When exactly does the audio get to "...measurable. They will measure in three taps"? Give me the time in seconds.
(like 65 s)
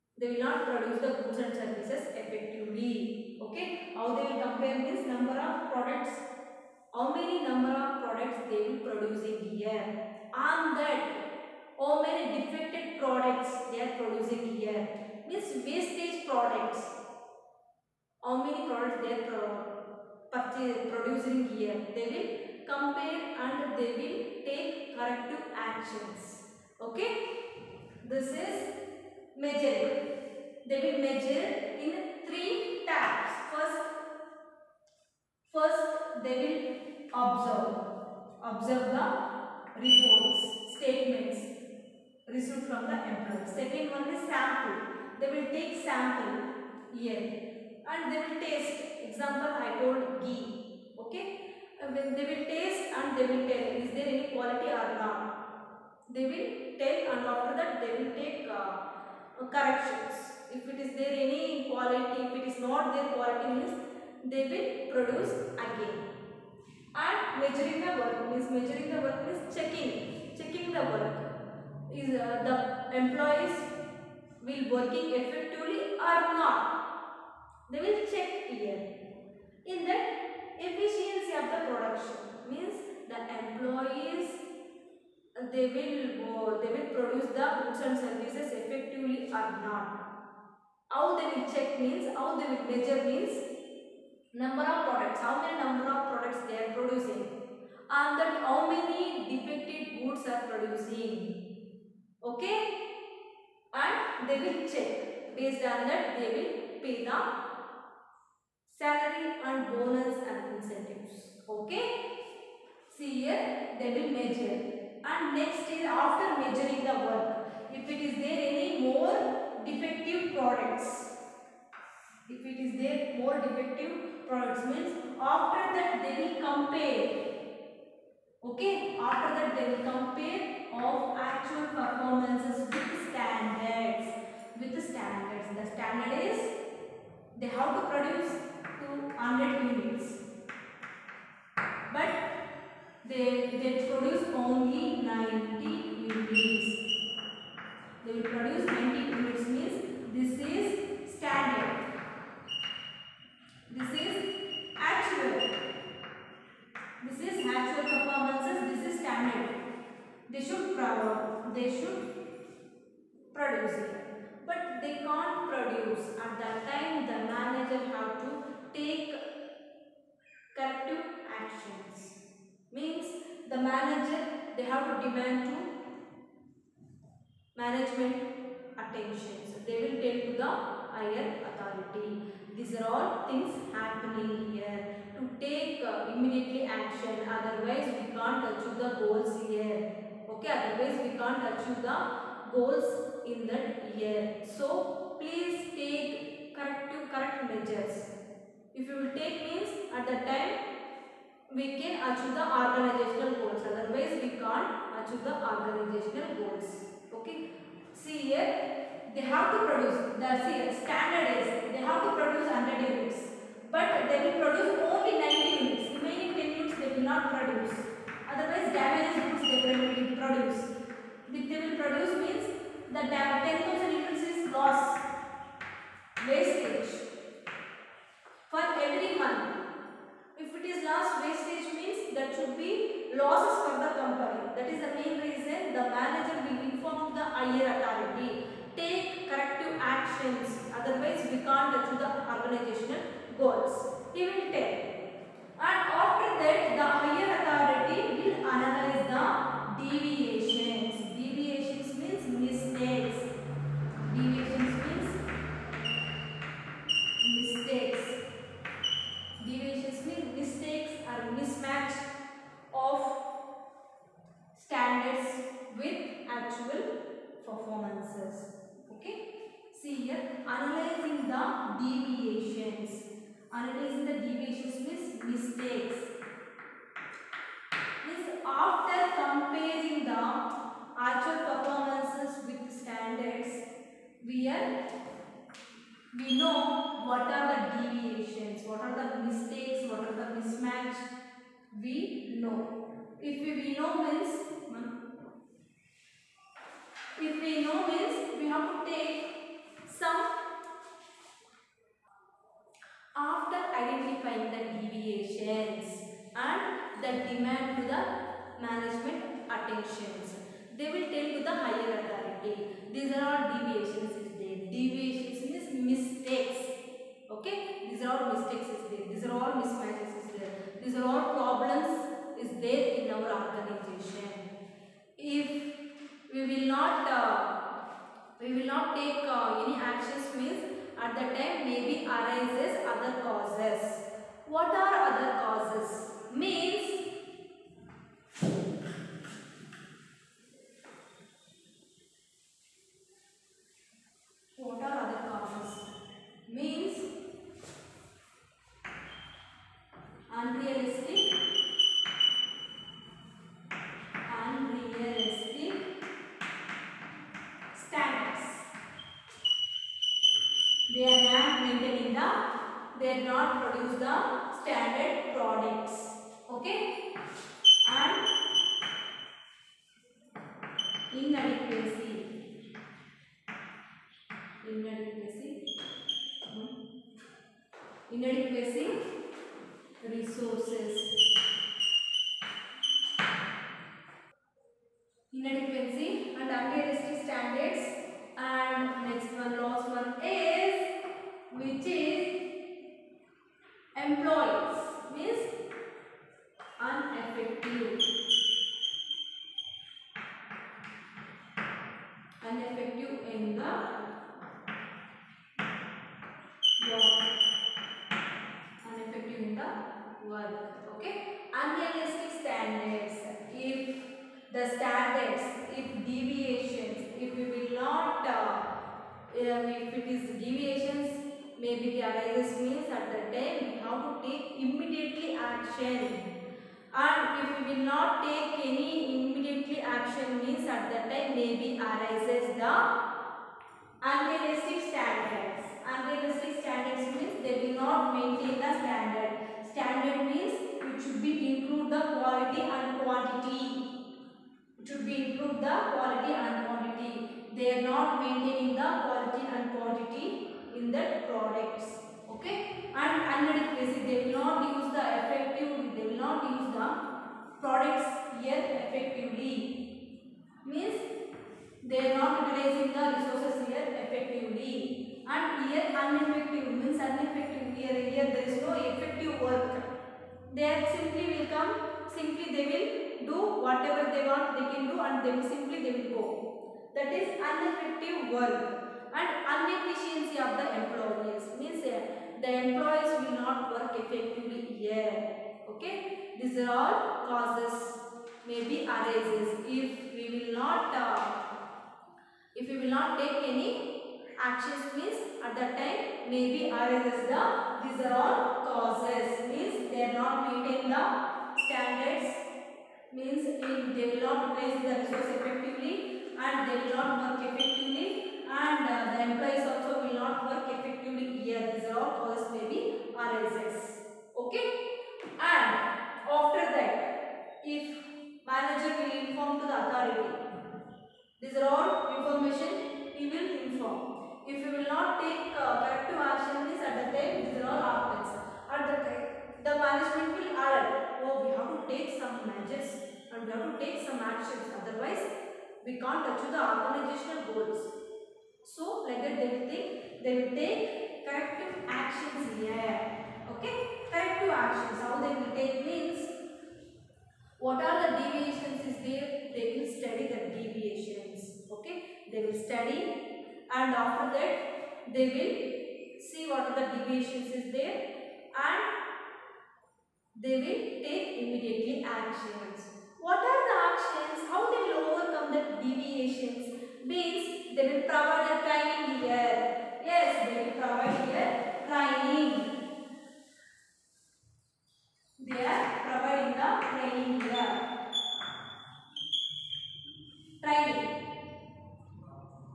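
29 s.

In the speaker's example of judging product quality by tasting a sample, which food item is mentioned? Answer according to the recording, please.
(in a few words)
ghee.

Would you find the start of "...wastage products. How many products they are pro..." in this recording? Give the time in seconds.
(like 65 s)
15 s.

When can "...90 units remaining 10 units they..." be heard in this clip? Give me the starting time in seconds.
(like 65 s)
215 s.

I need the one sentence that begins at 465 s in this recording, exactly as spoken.
And here ineffective means ineffective here, here there is no effective work.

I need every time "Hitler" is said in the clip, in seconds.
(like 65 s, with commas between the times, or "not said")
not said.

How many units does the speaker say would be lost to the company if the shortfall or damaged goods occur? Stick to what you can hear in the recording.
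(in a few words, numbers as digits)
10000.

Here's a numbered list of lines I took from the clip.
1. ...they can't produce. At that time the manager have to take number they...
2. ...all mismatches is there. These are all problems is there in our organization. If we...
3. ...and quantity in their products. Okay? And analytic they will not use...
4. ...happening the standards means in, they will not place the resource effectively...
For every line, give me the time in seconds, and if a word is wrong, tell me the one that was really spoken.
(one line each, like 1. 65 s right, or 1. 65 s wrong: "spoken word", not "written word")
1. 164 s wrong: "manager", not "number"
2. 319 s right
3. 449 s right
4. 500 s wrong: "maintaining", not "happening".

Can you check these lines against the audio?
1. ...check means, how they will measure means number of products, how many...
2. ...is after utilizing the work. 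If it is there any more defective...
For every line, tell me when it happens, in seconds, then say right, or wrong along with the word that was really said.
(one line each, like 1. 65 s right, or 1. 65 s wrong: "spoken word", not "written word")
1. 91 s right
2. 115 s wrong: "measuring", not "utilizing".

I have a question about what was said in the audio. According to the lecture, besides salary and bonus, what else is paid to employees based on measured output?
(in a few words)
incentives.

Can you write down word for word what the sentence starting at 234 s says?
That is the main reason the manager will inform the higher authority.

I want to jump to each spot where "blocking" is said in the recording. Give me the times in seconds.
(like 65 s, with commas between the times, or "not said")
not said.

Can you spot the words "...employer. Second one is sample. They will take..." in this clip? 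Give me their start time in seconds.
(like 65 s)
43 s.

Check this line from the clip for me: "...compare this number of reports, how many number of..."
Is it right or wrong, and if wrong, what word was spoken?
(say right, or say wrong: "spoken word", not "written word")
wrong: "products", not "reports".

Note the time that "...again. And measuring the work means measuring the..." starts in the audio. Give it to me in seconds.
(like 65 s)
65 s.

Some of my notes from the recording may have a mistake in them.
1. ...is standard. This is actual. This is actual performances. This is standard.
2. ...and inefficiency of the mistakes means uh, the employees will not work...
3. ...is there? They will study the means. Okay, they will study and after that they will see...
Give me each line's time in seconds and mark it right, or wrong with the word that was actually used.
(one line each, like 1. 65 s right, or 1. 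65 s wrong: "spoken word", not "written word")
1. 150 s right
2. 479 s wrong: "employees", not "mistakes"
3. 548 s wrong: "deviations", not "means".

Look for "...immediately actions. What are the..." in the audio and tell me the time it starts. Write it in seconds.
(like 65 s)
561 s.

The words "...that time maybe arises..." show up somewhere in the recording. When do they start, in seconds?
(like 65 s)
495 s.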